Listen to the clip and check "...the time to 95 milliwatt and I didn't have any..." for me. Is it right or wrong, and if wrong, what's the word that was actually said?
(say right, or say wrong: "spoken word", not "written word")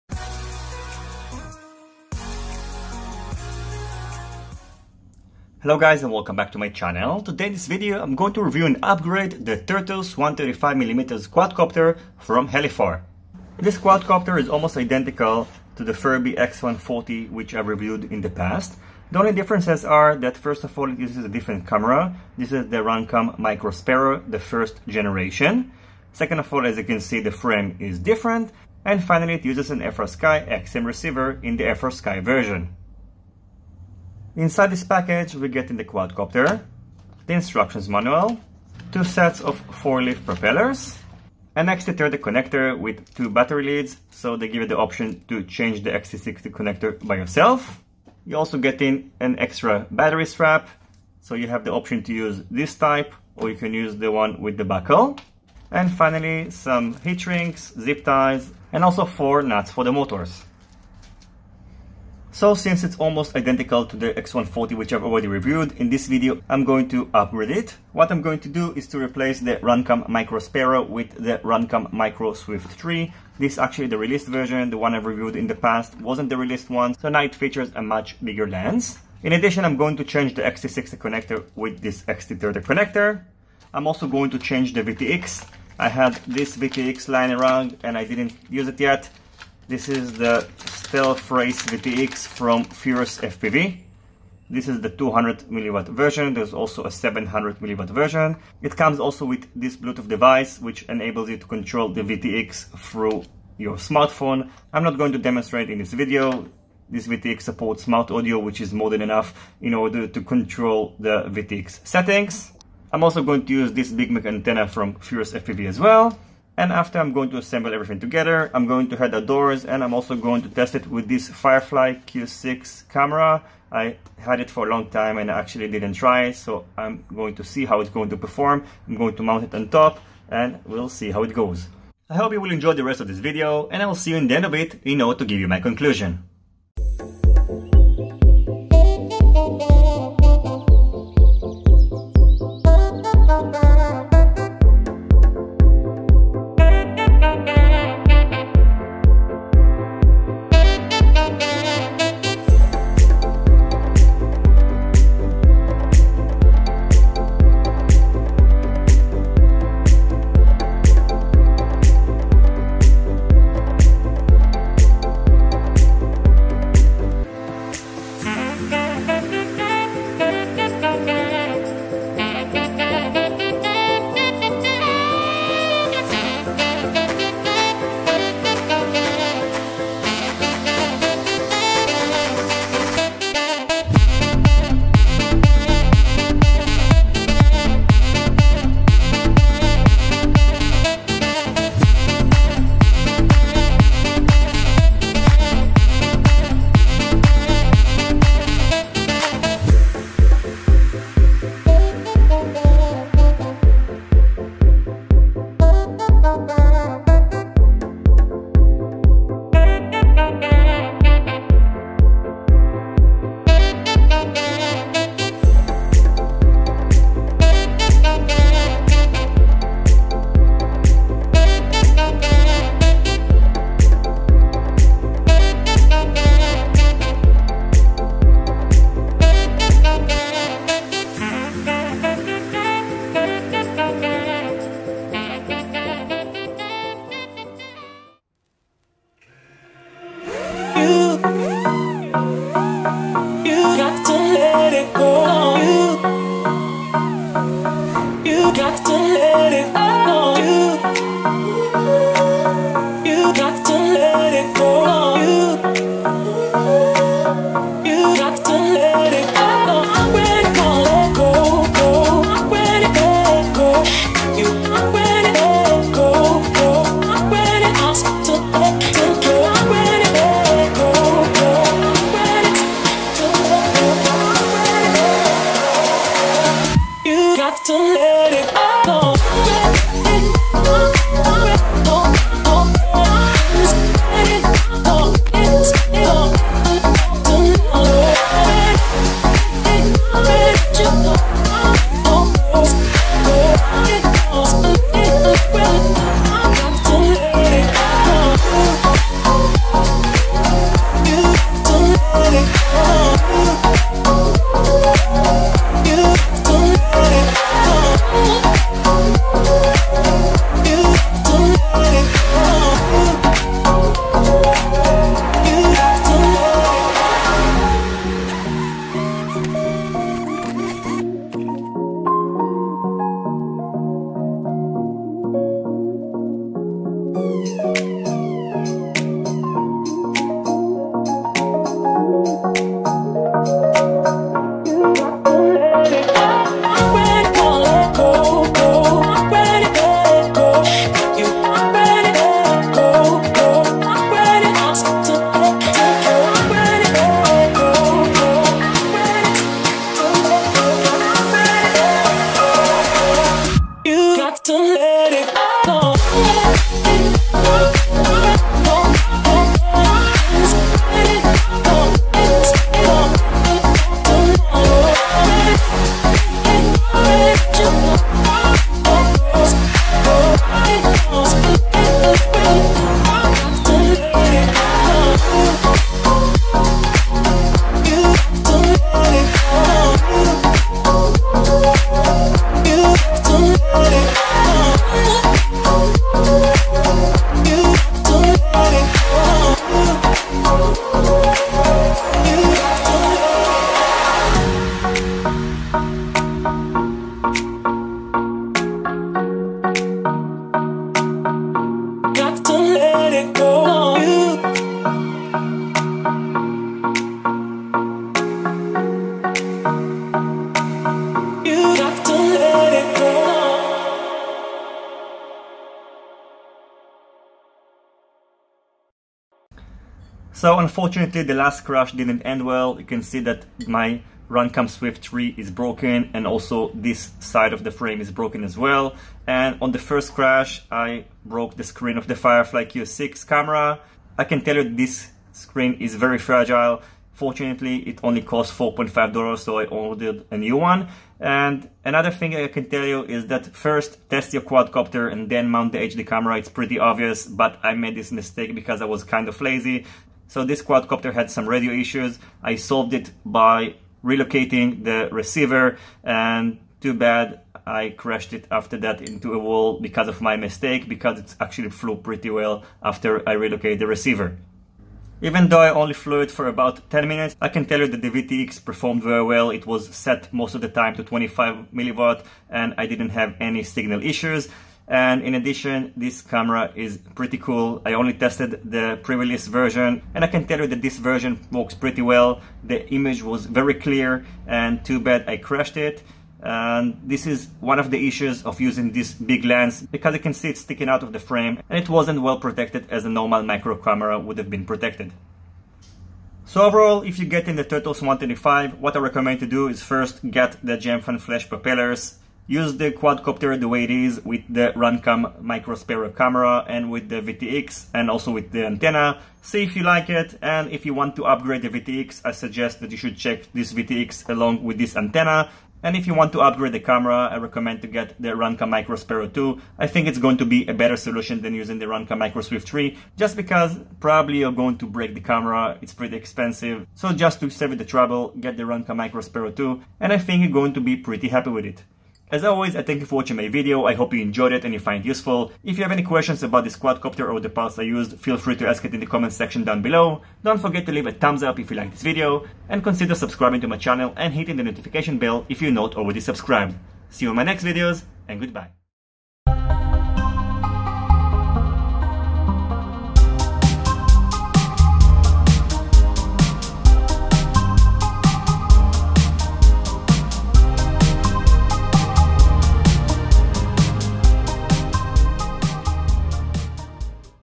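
wrong: "25", not "95".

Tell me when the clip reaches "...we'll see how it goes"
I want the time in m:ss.
2:10.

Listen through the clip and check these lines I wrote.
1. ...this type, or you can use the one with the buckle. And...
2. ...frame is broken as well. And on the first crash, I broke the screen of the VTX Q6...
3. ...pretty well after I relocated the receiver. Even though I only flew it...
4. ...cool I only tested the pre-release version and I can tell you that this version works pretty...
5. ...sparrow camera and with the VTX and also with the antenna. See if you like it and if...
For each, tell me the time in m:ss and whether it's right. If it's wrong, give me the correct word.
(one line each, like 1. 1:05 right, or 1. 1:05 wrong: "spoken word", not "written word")
1. 0:52 right
2. 7:07 wrong: "Firefly", not "VTX"
3. 7:41 right
4. 7:57 right
5. 8:25 right.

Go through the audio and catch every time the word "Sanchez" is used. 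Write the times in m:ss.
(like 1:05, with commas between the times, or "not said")
not said.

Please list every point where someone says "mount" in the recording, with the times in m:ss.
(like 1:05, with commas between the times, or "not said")
2:09, 7:25.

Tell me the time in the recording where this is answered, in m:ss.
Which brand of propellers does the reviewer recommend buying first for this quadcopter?
8:20.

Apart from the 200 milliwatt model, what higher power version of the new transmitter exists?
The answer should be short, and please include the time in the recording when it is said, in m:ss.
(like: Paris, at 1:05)
700 milliwatt, at 1:36.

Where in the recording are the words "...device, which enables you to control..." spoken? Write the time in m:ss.
1:40.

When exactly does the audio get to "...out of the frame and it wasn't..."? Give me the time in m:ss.
8:10.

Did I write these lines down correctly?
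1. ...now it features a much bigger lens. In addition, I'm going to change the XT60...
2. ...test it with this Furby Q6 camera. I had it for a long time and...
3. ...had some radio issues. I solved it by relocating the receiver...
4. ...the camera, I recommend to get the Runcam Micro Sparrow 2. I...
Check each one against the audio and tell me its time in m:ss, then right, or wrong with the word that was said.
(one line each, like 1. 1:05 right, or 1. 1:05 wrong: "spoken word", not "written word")
1. 1:17 right
2. 2:00 wrong: "Firefly", not "Furby"
3. 7:31 right
4. 8:36 right.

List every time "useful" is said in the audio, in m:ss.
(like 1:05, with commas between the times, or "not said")
8:55.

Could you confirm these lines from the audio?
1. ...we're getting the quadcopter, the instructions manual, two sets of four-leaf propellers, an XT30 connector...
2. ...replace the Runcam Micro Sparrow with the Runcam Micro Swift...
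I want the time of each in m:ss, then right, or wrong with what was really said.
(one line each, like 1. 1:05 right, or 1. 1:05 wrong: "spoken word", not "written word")
1. 0:35 right
2. 1:08 right.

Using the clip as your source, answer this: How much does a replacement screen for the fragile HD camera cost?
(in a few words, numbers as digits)
$4.5.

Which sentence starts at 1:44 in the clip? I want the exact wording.
I'm not going to demonstrate in this video.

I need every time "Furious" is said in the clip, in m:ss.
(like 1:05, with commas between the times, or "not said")
1:32, 1:54.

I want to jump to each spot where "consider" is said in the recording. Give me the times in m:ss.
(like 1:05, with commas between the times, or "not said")
9:02.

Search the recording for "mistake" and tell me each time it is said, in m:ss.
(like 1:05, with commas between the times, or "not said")
7:28, 7:40.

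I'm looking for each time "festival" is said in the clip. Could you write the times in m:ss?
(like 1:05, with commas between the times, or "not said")
not said.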